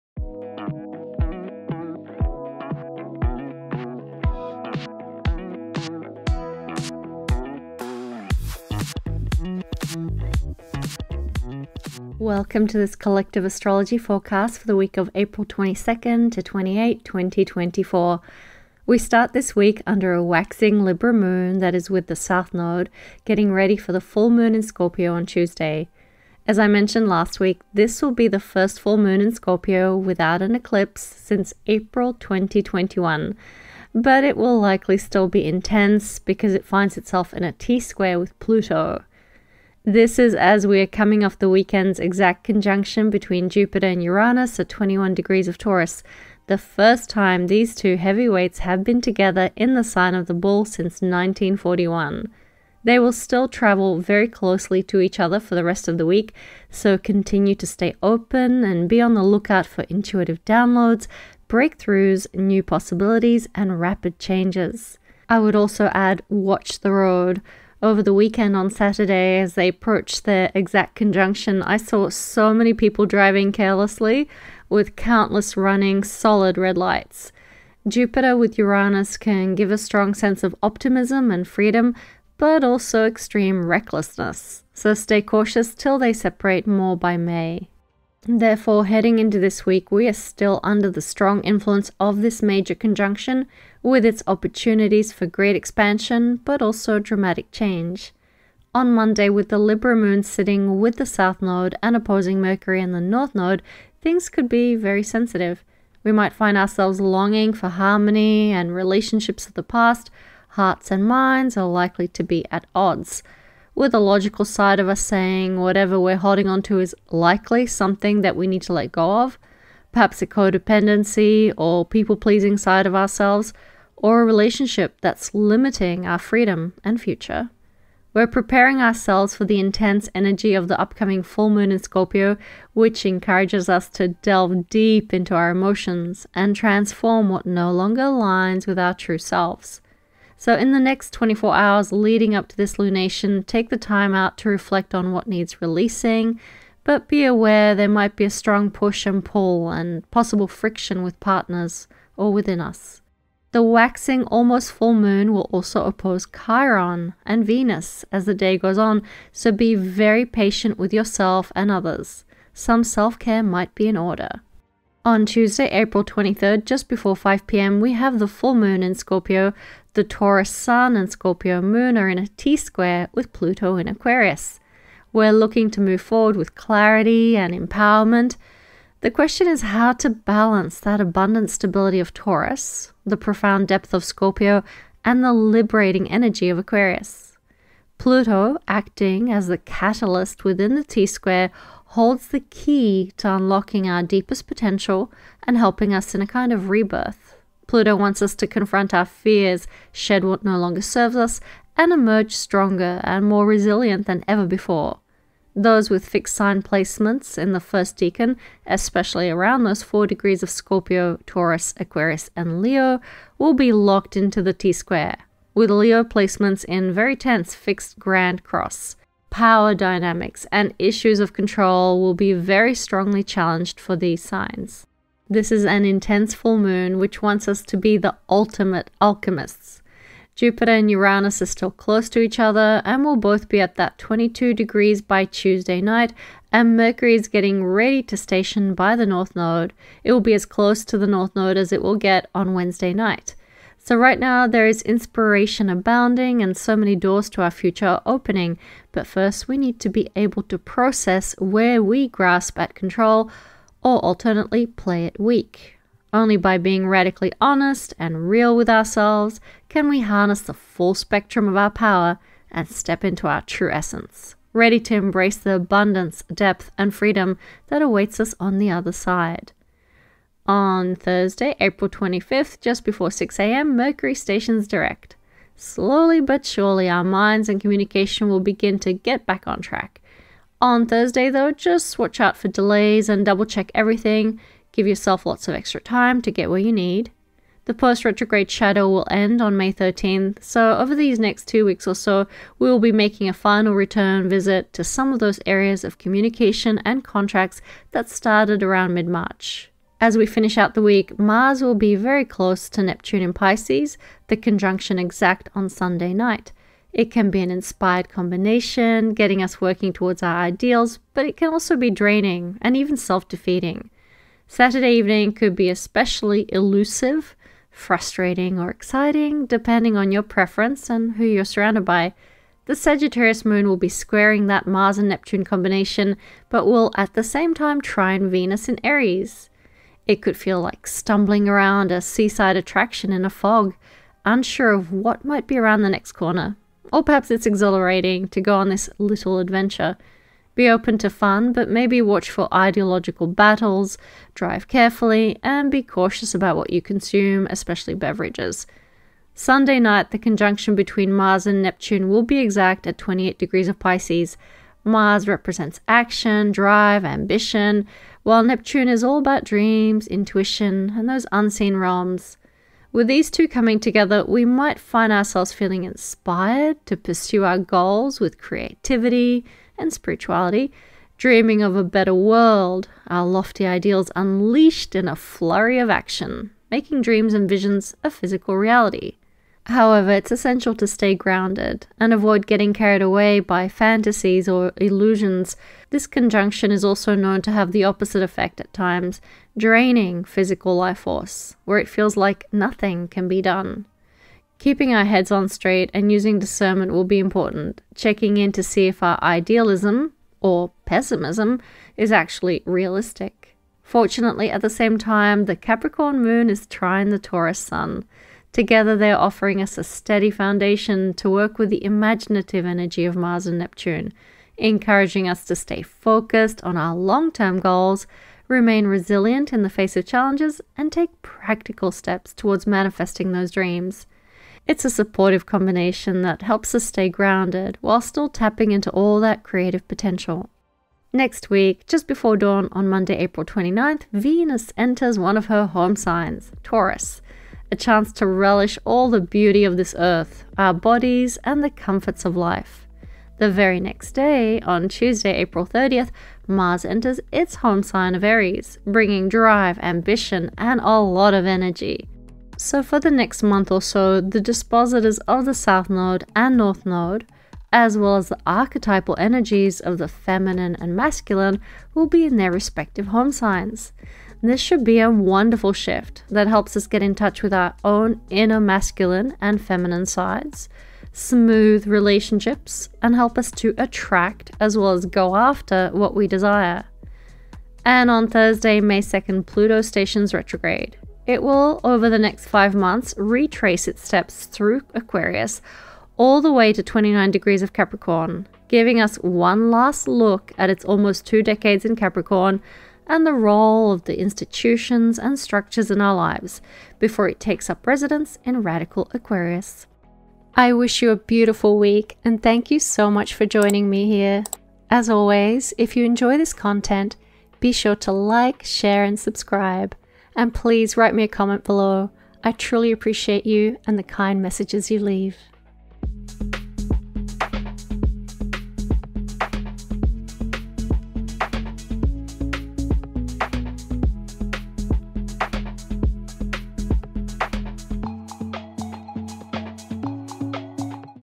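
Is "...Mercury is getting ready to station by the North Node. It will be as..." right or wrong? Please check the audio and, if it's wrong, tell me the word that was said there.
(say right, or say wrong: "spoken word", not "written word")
right.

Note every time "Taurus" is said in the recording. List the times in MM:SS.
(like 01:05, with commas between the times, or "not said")
00:45, 02:50, 03:02, 03:31, 06:47, 07:16.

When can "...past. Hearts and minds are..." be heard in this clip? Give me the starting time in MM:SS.
01:49.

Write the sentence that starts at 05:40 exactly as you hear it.
Be open to fun, but maybe watch for ideological battles, drive carefully, and be cautious about what you consume, especially beverages.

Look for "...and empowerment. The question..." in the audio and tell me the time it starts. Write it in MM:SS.
02:57.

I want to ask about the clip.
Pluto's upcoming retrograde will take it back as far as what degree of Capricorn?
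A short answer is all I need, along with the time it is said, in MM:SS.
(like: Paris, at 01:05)
29 degrees, at 08:06.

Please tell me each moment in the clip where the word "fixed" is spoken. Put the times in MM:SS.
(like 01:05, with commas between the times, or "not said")
03:26, 03:37.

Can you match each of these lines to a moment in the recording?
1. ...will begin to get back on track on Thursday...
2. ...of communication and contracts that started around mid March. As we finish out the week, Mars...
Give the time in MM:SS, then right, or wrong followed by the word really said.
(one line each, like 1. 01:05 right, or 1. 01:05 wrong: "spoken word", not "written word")
1. 04:38 right
2. 04:55 right.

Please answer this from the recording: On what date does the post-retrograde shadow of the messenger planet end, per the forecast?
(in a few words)
May 13th.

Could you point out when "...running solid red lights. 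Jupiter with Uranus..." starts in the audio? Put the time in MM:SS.
01:15.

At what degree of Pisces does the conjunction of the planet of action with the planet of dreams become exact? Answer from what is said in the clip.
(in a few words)
28 degrees.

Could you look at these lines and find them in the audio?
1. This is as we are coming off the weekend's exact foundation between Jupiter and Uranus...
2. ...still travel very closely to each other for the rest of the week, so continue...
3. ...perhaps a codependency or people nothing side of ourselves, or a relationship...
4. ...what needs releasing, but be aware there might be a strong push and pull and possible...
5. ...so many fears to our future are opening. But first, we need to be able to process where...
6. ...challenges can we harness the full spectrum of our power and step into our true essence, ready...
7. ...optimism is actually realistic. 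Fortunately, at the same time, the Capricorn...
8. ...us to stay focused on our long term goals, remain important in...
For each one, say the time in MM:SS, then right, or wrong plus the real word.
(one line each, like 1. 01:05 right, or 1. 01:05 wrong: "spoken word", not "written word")
1. 00:39 wrong: "conjunction", not "foundation"
2. 00:53 right
3. 01:59 wrong: "pleasing", not "nothing"
4. 02:25 right
5. 04:06 wrong: "doors", not "fears"
6. 04:18 wrong: "ourselves", not "challenges"
7. 06:40 wrong: "pessimism", not "optimism"
8. 06:55 wrong: "resilient", not "important".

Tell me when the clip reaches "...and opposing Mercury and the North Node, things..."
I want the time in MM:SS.
01:41.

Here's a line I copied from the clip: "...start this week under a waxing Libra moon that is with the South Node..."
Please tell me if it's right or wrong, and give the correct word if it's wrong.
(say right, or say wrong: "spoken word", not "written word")
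right.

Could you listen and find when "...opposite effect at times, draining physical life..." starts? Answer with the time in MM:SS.
06:27.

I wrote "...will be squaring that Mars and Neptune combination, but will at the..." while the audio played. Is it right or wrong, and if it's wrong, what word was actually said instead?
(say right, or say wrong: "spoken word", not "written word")
right.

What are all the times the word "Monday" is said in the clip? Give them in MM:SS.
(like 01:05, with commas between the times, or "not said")
01:38, 07:12.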